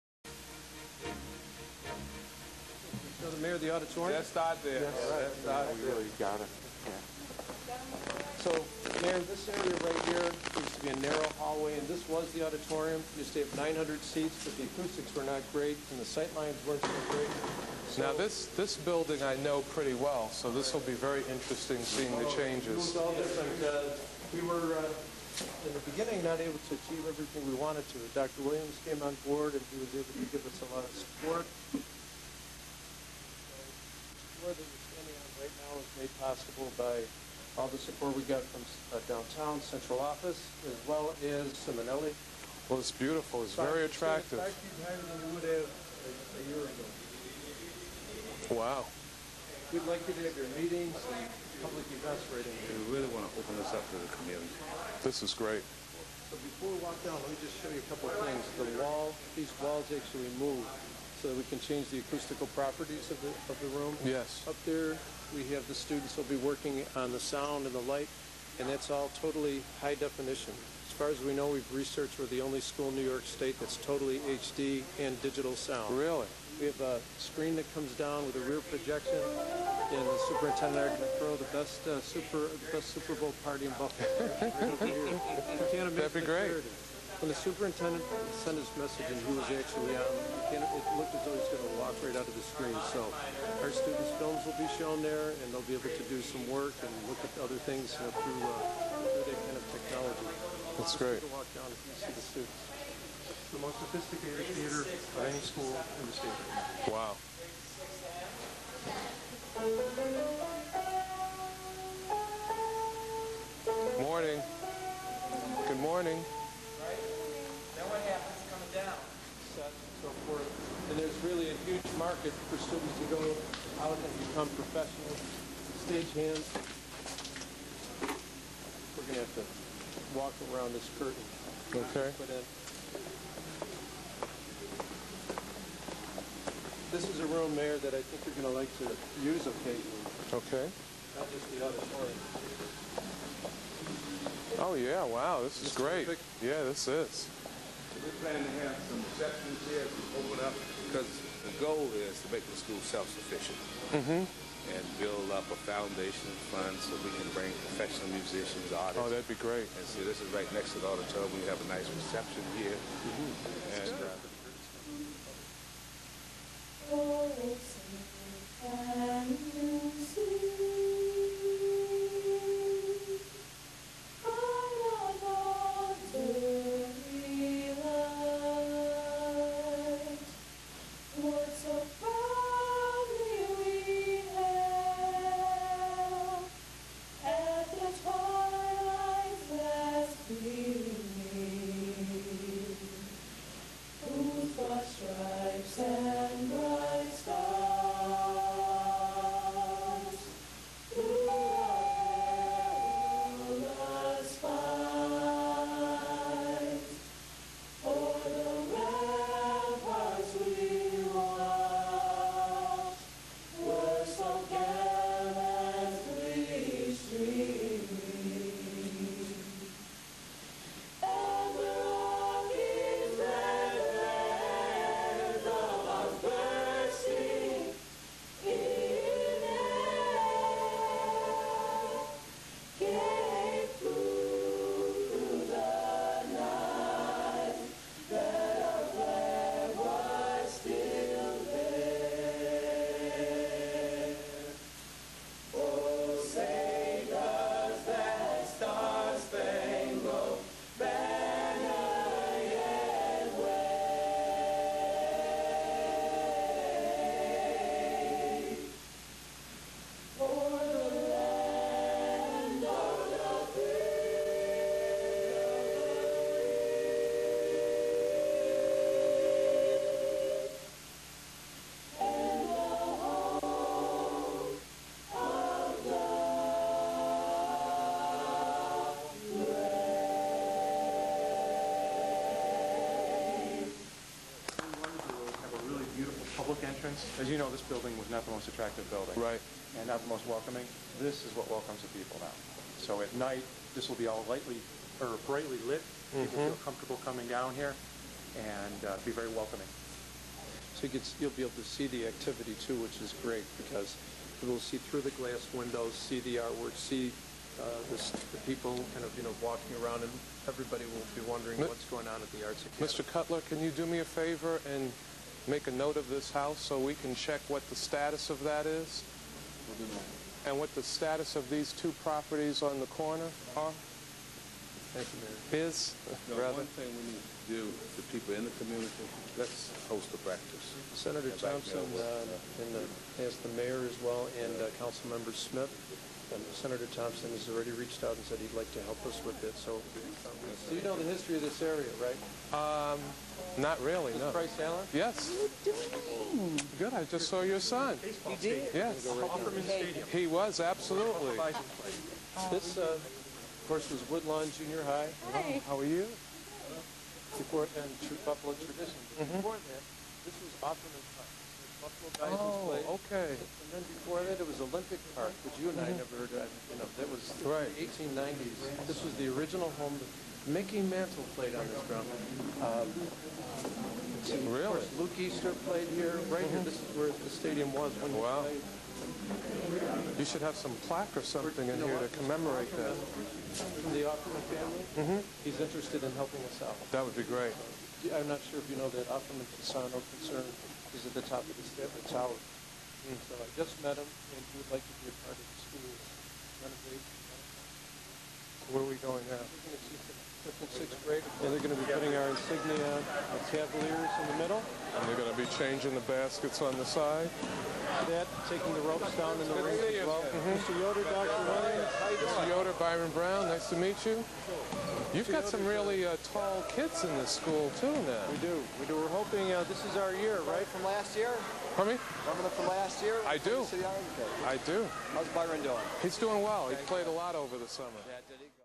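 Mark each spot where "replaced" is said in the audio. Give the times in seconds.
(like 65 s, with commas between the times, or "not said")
not said.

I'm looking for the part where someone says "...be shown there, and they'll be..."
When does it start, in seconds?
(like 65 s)
94 s.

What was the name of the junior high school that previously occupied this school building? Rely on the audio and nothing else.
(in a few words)
Woodlawn Junior High.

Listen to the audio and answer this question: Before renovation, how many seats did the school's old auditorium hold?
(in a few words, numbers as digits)
900.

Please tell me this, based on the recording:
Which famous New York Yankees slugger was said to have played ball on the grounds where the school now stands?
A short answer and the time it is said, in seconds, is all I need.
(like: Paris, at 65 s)
Mickey Mantle, at 370 s.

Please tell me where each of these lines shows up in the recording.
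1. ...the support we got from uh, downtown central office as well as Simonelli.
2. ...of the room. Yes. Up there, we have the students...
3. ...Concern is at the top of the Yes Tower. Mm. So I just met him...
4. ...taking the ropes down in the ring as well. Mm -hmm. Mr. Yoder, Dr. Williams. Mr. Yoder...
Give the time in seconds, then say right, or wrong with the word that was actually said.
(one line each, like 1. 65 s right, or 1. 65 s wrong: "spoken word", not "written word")
1. 37 s right
2. 63 s right
3. 389 s wrong: "Statler", not "Yes"
4. 408 s right.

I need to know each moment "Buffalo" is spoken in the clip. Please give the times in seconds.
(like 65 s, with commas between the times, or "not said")
83 s, 358 s.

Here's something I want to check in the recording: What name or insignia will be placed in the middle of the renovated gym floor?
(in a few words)
Cavaliers.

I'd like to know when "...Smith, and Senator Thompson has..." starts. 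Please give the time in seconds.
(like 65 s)
335 s.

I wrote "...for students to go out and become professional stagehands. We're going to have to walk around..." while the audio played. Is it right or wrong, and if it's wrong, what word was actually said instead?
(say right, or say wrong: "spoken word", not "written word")
right.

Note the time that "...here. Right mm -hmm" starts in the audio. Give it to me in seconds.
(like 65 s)
375 s.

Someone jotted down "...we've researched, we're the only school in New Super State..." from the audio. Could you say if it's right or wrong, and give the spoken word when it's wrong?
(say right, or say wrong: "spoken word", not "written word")
wrong: "York", not "Super".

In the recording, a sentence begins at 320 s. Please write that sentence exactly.
And what the status of these two properties on the corner are?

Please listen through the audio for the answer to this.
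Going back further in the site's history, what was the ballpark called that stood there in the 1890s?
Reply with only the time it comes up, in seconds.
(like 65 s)
364 s.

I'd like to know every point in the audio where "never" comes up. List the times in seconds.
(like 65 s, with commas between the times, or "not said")
365 s.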